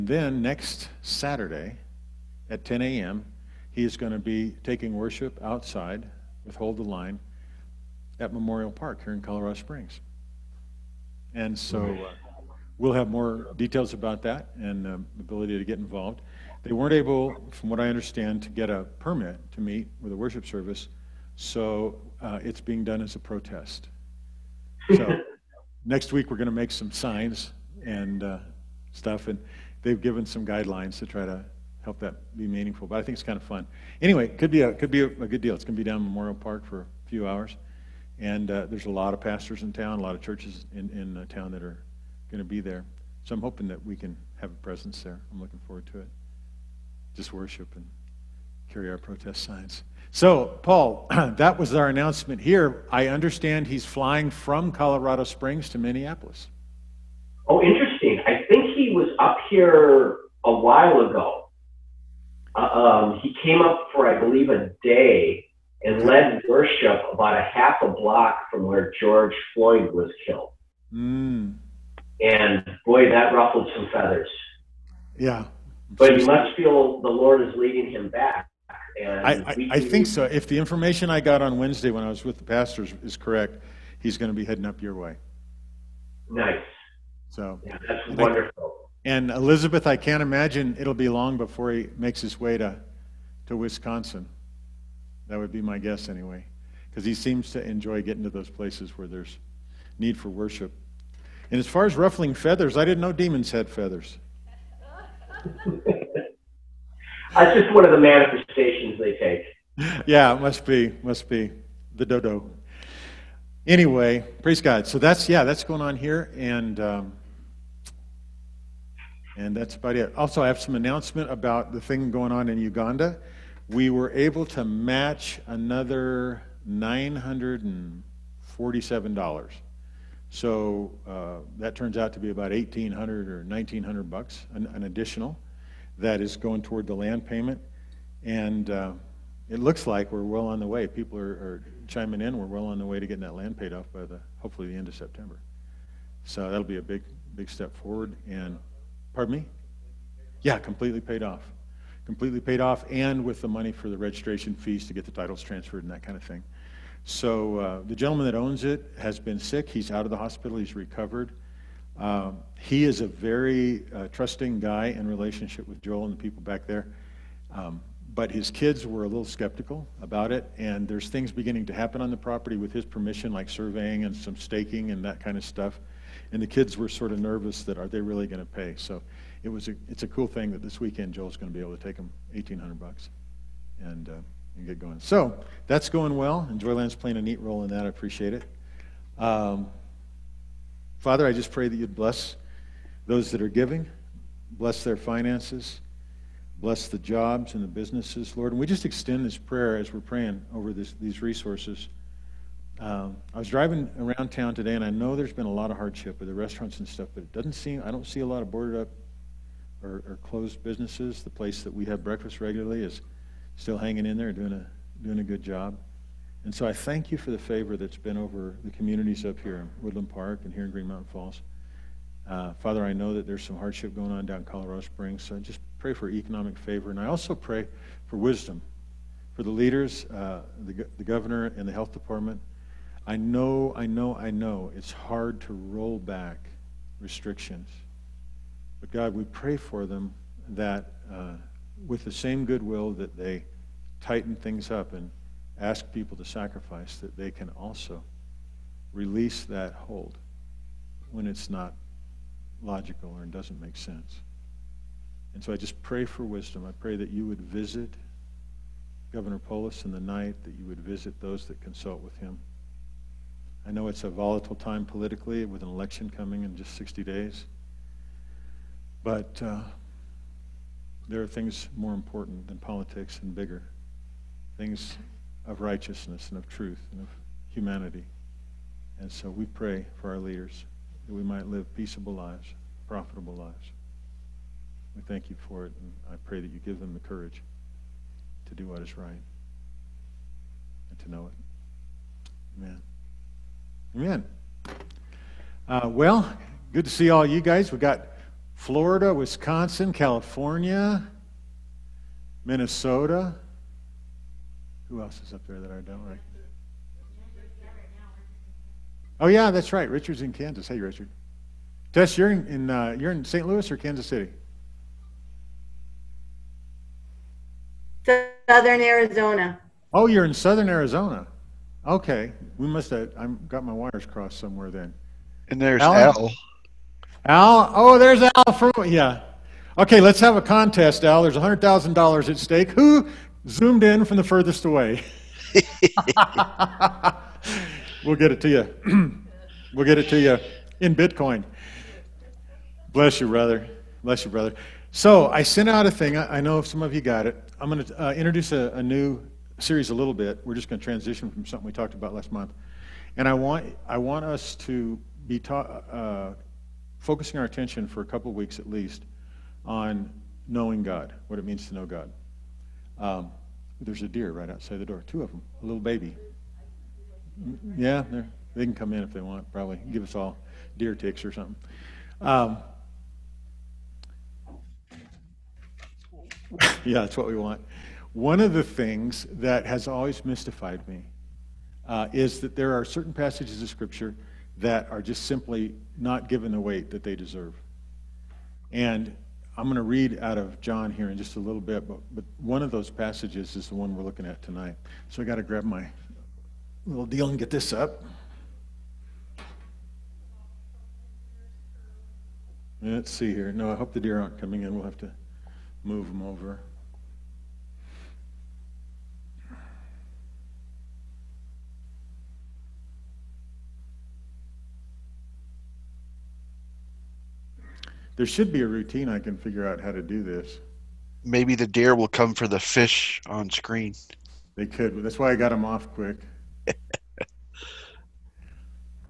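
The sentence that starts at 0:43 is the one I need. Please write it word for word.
So I'm hoping that we can have a presence there.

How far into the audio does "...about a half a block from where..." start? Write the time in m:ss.
1:07.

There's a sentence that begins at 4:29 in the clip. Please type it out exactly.
But uh, there are things more important than politics and bigger, things of righteousness and of truth and of humanity.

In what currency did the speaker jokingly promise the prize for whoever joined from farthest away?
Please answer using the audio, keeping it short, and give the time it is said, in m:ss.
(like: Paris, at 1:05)
Bitcoin, at 5:40.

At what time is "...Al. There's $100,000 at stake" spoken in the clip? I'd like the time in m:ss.
5:31.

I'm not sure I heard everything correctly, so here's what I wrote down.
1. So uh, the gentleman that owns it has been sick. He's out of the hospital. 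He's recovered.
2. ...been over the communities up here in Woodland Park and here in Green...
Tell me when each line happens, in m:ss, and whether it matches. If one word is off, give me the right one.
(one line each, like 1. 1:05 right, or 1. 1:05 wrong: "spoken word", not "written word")
1. 2:37 right
2. 3:37 right.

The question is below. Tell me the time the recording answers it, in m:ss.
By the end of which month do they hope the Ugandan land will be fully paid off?
2:24.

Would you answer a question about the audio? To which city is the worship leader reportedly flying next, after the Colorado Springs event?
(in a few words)
Minneapolis.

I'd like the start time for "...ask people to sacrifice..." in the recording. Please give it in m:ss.
4:05.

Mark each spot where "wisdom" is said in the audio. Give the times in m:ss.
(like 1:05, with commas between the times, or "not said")
3:48, 4:16.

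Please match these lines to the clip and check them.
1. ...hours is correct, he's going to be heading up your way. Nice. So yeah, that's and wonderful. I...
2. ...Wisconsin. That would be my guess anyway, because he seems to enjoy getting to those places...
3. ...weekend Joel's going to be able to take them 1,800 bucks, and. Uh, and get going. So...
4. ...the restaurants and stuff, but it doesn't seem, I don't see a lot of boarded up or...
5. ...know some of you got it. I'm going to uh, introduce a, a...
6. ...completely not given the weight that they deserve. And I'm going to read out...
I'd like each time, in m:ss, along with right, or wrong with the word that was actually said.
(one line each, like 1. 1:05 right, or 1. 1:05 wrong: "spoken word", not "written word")
1. 1:22 wrong: "pastors", not "hours"
2. 1:33 right
3. 3:00 right
4. 3:26 right
5. 5:46 right
6. 6:25 wrong: "simply", not "completely".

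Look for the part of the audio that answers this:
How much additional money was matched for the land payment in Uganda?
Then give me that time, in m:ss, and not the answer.
2:06.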